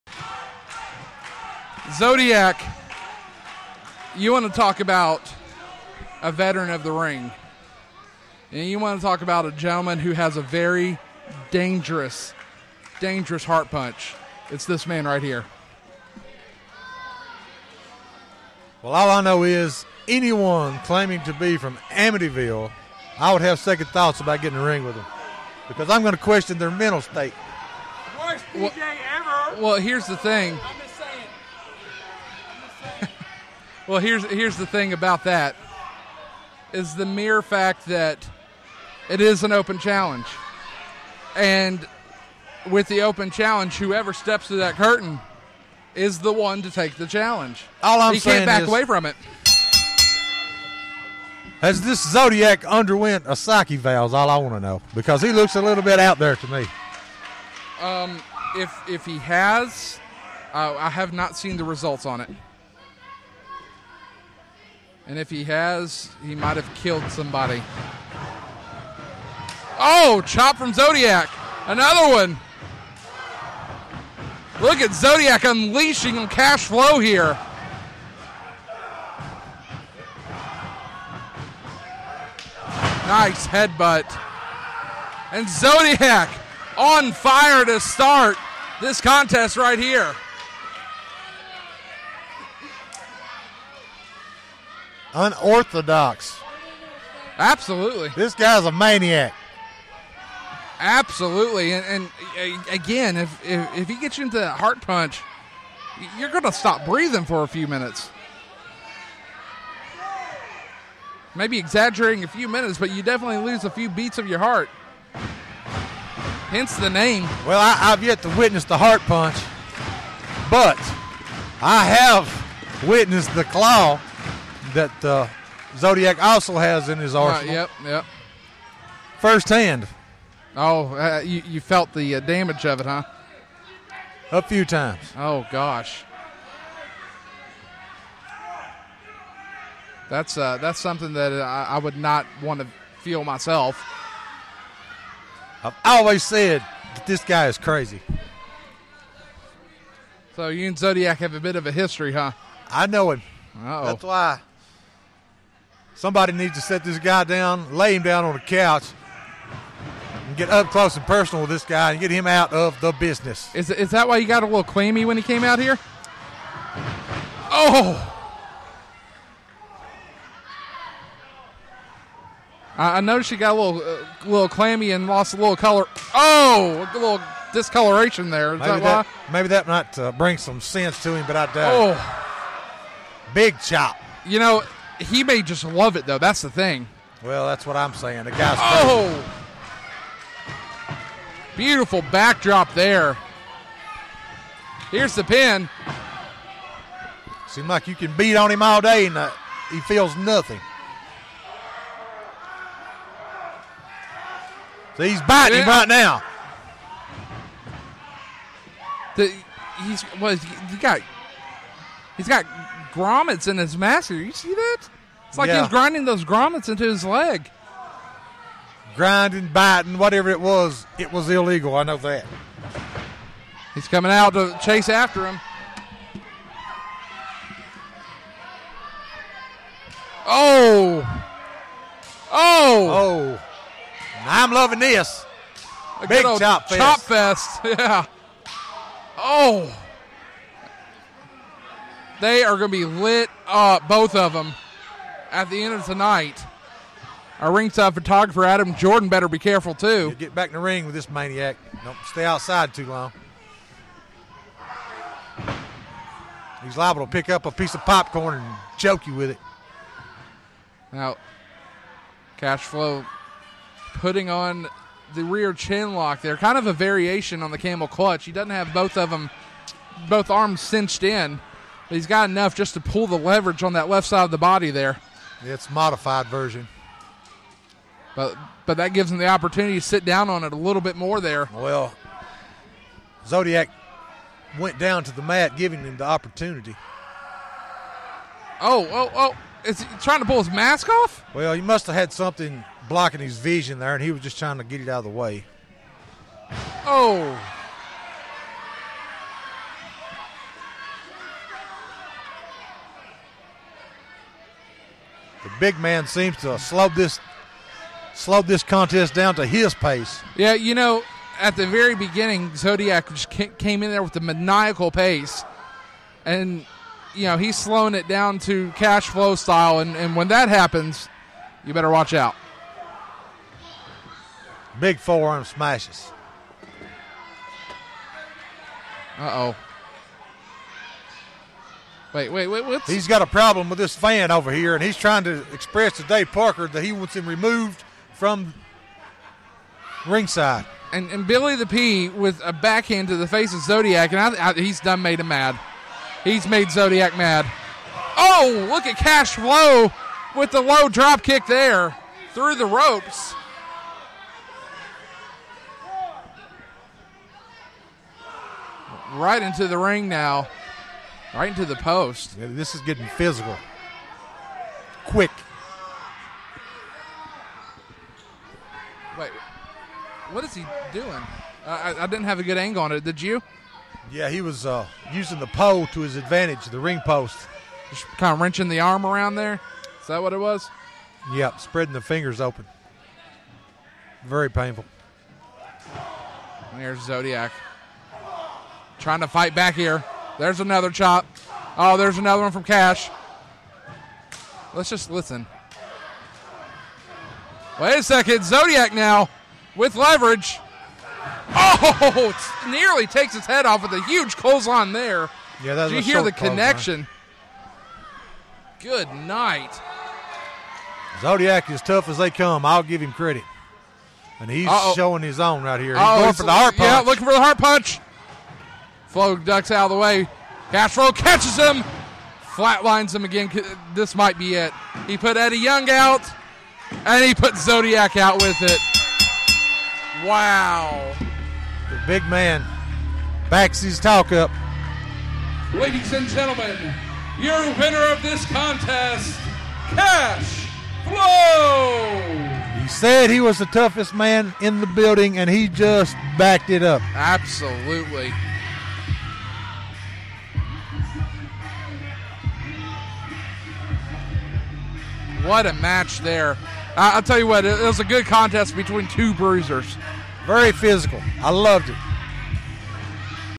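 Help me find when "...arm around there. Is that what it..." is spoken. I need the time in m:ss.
6:18.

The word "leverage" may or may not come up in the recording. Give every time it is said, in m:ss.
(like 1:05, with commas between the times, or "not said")
4:33, 6:39.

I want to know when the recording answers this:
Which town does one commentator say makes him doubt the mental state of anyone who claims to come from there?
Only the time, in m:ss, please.
0:21.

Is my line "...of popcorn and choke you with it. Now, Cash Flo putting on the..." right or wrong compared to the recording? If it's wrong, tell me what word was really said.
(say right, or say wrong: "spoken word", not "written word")
right.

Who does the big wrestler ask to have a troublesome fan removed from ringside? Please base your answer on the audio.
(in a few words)
Dave Parker.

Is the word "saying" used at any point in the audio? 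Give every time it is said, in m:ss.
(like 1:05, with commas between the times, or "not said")
0:48, 3:07.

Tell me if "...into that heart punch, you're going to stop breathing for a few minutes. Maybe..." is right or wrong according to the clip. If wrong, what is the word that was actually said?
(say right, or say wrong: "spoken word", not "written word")
right.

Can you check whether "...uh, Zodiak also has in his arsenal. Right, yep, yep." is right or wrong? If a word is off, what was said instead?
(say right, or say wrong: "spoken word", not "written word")
right.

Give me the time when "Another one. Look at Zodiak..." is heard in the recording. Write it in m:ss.
1:11.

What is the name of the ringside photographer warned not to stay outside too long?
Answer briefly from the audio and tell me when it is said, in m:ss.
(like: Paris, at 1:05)
Adam Jordan, at 4:08.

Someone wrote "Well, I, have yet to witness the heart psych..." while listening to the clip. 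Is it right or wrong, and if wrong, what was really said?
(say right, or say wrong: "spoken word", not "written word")
wrong: "punch", not "psych".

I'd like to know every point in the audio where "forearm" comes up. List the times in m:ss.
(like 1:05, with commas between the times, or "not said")
5:24.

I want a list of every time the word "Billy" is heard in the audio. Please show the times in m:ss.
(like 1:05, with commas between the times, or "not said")
5:41.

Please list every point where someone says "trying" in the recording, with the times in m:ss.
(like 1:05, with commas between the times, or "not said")
4:50, 4:54, 5:34, 6:28.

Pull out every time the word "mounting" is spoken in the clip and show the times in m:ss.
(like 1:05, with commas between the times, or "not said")
not said.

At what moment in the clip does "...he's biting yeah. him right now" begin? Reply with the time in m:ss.
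3:25.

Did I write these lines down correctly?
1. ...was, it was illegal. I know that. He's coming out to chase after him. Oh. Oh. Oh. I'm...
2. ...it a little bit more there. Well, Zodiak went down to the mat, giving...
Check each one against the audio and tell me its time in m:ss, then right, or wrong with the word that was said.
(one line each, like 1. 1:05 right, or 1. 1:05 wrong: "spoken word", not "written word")
1. 3:40 right
2. 4:40 right.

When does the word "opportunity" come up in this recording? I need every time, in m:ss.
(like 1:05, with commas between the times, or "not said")
4:39, 4:46.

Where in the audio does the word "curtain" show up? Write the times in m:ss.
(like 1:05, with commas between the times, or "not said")
0:44.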